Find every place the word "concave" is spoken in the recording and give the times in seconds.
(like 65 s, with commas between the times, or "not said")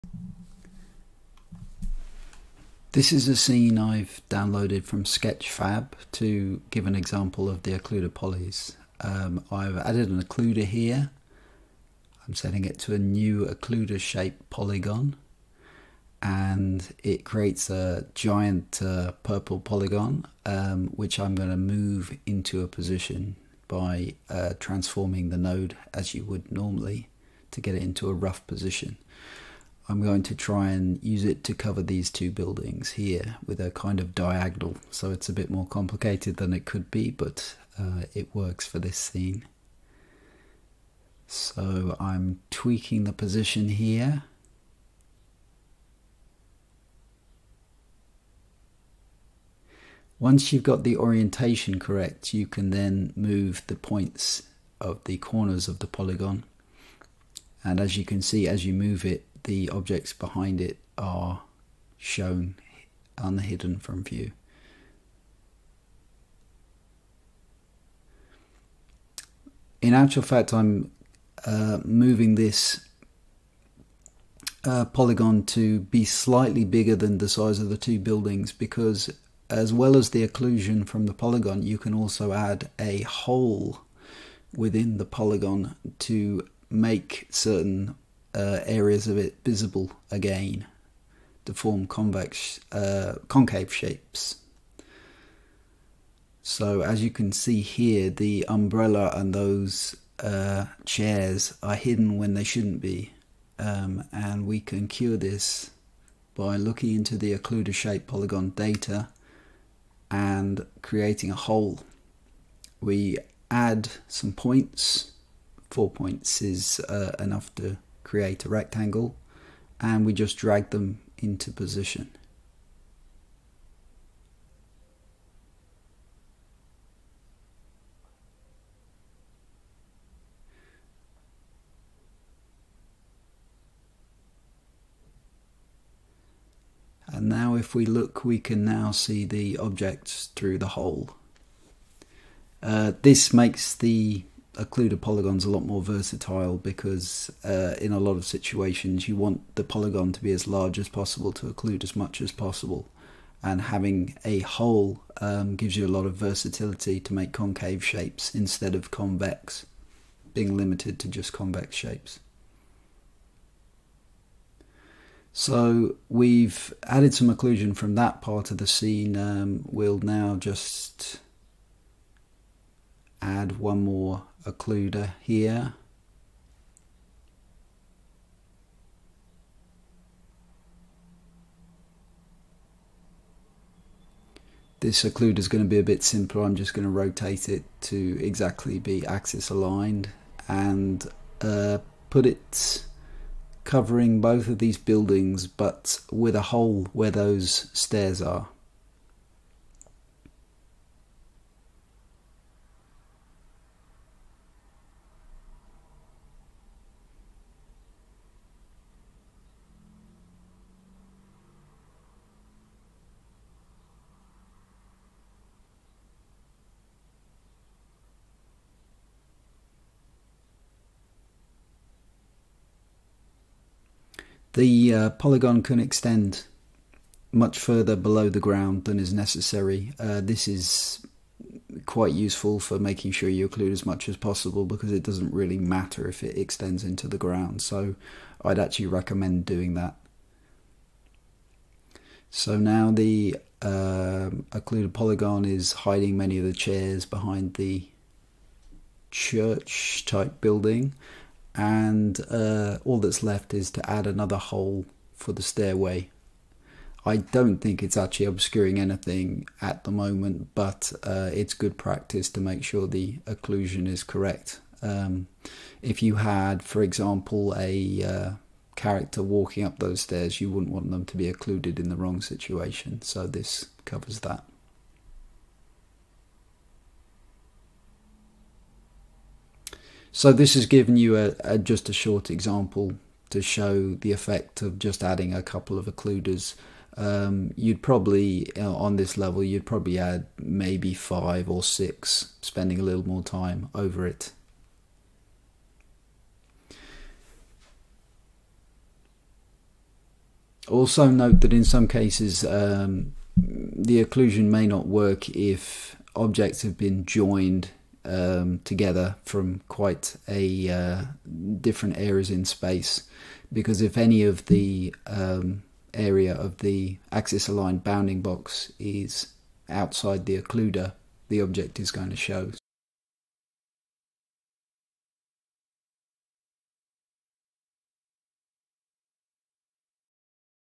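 93 s, 157 s.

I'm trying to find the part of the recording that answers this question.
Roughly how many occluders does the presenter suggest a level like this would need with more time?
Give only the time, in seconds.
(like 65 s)
290 s.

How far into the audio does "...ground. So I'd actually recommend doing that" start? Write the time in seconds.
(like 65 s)
237 s.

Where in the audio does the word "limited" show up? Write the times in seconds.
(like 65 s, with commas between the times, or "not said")
160 s.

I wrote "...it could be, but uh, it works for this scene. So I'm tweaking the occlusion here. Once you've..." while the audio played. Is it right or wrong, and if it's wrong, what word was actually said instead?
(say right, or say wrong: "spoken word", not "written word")
wrong: "position", not "occlusion".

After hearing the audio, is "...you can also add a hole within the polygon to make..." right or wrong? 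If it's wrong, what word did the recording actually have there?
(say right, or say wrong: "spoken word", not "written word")
right.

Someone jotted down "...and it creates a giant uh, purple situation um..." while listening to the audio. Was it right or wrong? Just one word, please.
wrong.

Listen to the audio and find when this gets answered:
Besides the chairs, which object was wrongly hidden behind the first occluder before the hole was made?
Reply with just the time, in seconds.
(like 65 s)
98 s.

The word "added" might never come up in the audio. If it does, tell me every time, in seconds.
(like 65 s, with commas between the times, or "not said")
9 s, 166 s.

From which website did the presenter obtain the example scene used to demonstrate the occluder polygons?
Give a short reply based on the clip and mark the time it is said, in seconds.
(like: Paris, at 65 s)
Sketchfab, at 5 s.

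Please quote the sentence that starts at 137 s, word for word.
And now if we look, we can now see the objects through the hole.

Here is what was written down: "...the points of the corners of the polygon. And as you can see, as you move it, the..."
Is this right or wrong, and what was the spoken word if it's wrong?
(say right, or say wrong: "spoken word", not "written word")
right.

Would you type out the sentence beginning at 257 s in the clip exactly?
I don't think it's actually obscuring anything at the moment, but uh, it's good practice to make sure the occlusion is correct.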